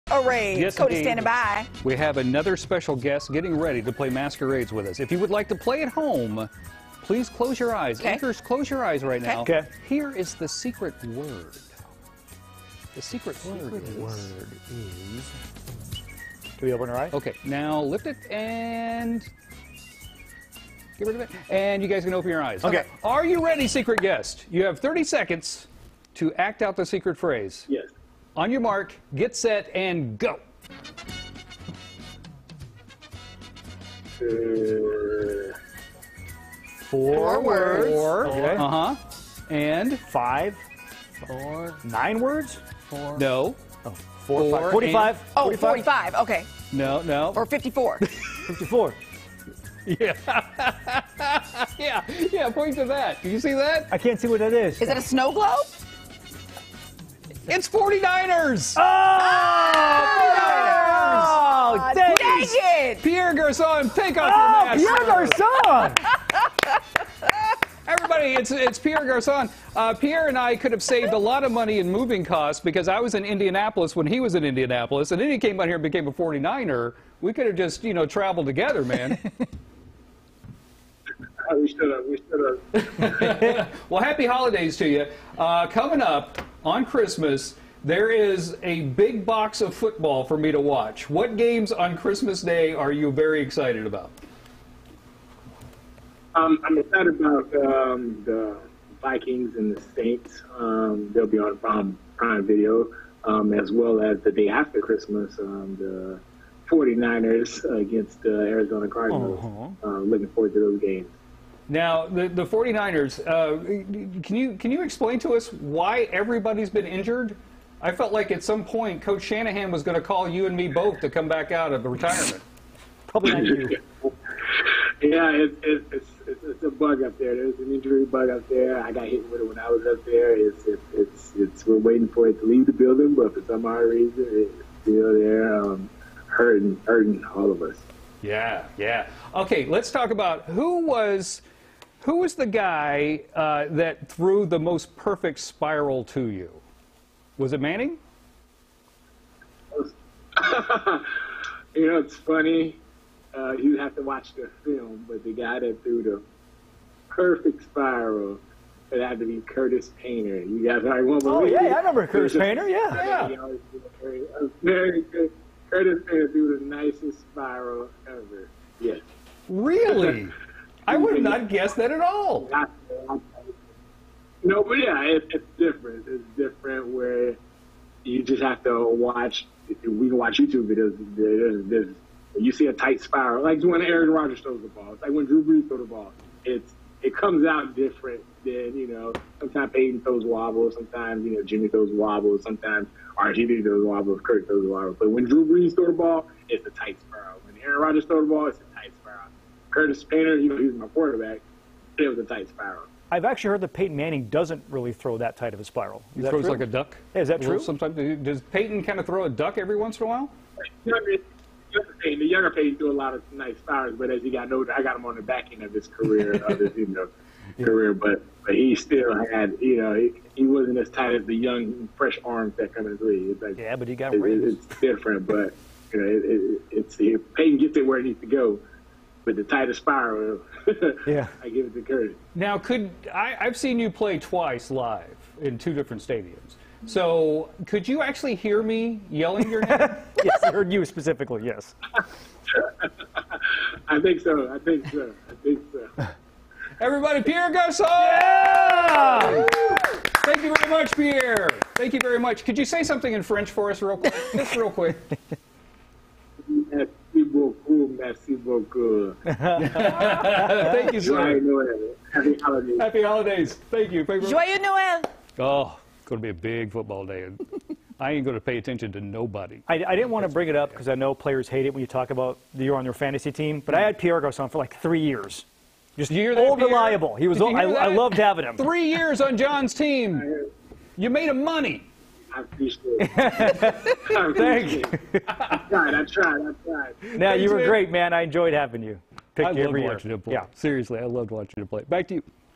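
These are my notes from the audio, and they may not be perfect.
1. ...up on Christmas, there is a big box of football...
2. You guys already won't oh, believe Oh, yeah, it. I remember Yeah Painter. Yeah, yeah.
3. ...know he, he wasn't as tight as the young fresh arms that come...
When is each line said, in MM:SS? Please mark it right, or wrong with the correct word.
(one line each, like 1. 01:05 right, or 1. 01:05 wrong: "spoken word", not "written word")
1. 01:26 right
2. 02:40 wrong: "Curtis", not "Yeah"
3. 03:39 right.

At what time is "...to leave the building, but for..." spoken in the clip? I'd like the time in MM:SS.
02:12.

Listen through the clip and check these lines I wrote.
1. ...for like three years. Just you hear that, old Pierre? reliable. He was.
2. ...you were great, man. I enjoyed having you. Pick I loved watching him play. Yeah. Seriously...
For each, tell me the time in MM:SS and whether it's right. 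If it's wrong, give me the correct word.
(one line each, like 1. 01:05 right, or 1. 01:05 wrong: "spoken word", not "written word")
1. 04:34 right
2. 04:47 right.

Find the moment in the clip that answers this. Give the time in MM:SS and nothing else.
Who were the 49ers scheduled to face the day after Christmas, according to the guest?
01:48.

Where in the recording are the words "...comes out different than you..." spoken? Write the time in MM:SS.
03:07.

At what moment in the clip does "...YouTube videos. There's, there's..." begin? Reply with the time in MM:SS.
03:00.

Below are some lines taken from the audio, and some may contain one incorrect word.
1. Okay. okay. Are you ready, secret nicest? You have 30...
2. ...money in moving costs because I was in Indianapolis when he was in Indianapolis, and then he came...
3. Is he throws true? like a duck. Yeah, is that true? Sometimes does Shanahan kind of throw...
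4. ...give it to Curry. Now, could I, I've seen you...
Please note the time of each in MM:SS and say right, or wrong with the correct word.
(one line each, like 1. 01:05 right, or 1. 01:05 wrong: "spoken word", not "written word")
1. 00:22 wrong: "guest", not "nicest"
2. 01:11 right
3. 03:26 wrong: "Peyton", not "Shanahan"
4. 03:51 right.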